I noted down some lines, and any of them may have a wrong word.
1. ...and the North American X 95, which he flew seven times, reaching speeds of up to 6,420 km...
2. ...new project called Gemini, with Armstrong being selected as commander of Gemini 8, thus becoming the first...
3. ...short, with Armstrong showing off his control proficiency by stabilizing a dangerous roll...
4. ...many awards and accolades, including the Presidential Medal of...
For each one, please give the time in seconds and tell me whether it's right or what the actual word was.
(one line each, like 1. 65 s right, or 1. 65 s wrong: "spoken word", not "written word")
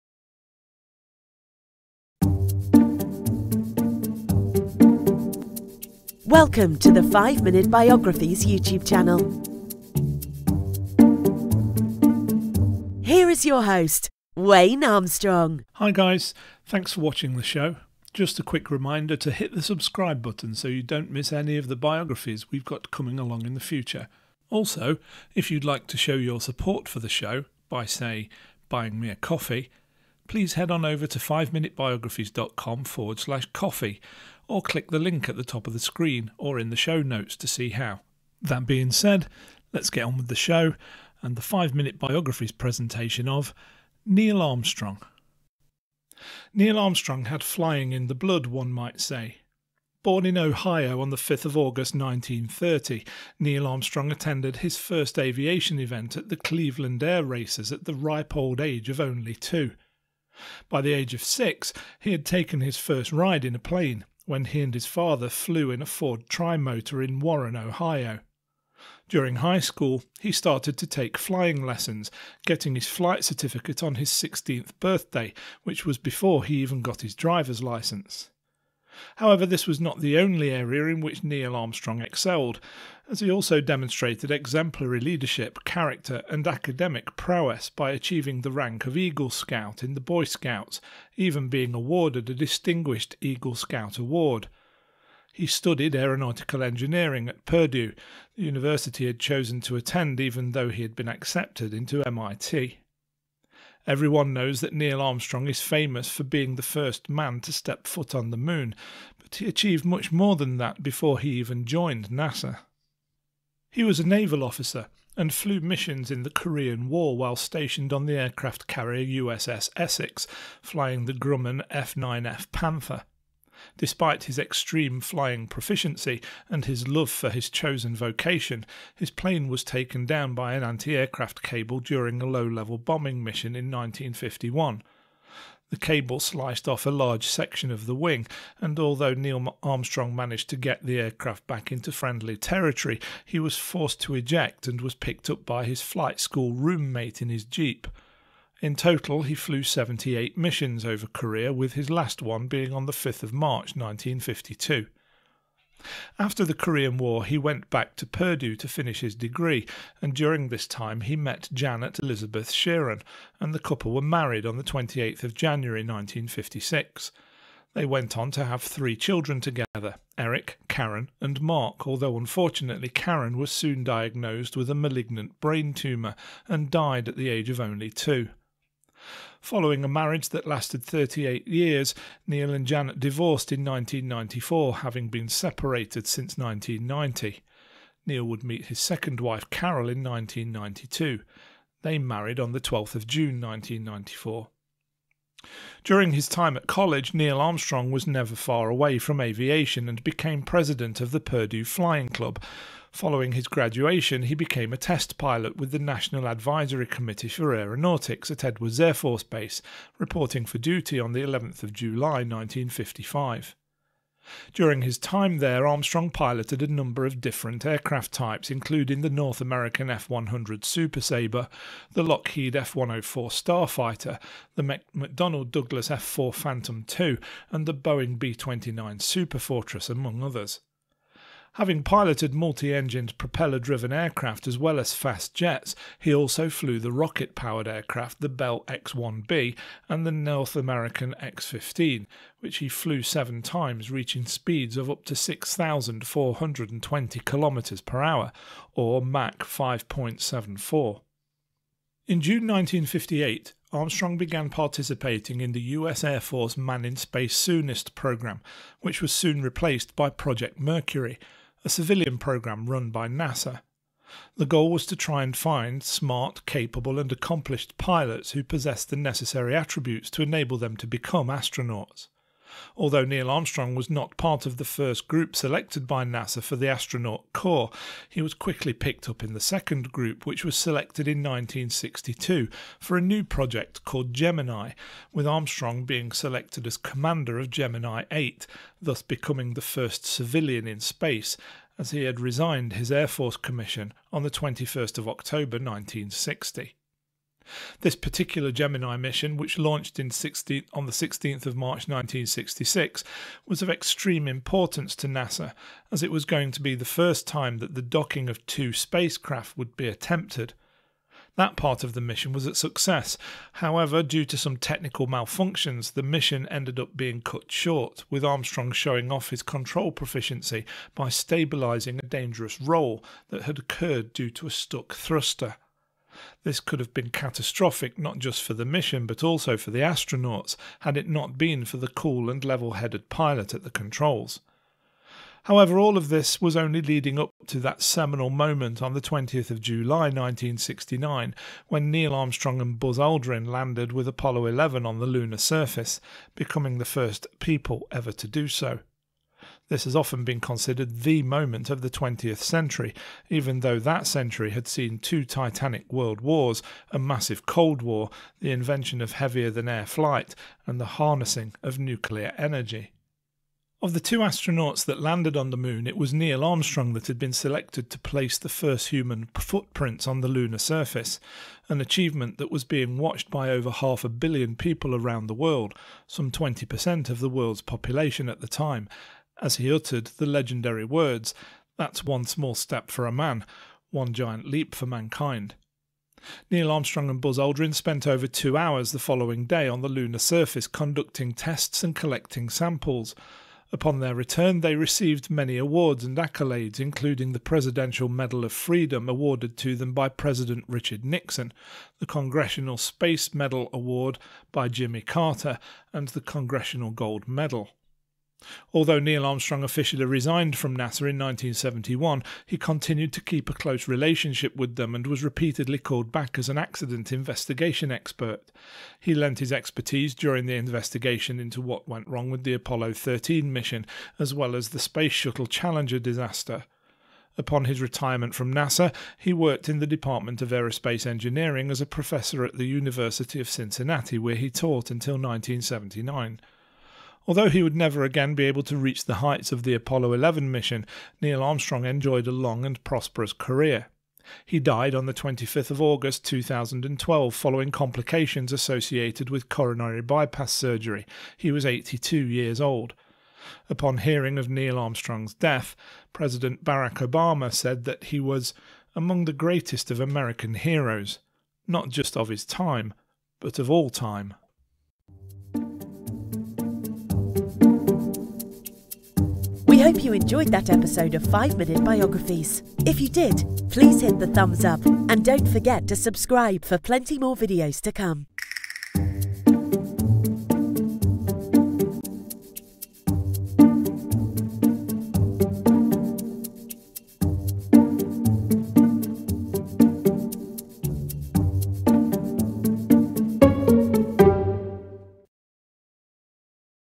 1. 239 s wrong: "15", not "95"
2. 283 s right
3. 317 s right
4. 395 s right.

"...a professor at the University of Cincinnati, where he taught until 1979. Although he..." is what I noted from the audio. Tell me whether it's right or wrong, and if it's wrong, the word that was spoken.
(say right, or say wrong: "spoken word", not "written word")
right.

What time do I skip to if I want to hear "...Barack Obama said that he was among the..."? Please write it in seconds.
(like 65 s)
456 s.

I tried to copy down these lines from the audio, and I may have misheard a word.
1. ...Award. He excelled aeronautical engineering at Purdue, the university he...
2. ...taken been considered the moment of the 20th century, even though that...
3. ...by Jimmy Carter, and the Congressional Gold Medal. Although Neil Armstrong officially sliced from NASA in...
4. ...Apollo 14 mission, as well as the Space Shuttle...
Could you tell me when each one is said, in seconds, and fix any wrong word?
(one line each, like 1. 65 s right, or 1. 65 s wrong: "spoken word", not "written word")
1. 93 s wrong: "studied", not "excelled"
2. 349 s wrong: "often", not "taken"
3. 404 s wrong: "resigned", not "sliced"
4. 422 s wrong: "13", not "14".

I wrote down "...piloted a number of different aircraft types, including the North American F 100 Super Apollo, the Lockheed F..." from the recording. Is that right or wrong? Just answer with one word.
wrong.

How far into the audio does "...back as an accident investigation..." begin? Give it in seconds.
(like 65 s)
416 s.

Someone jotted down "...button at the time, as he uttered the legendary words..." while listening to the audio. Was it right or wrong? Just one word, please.
wrong.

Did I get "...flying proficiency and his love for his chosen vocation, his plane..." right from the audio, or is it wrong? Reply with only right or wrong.
right.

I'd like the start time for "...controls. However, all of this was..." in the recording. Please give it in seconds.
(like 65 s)
333 s.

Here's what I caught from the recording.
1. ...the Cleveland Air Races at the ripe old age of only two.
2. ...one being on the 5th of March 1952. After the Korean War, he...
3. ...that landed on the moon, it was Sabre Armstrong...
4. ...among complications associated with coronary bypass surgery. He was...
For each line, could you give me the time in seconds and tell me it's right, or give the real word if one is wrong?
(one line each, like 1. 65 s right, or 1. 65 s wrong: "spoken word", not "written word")
1. 56 s right
2. 152 s right
3. 364 s wrong: "Neil", not "Sabre"
4. 447 s wrong: "following", not "among".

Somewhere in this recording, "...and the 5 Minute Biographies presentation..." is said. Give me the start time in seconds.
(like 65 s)
41 s.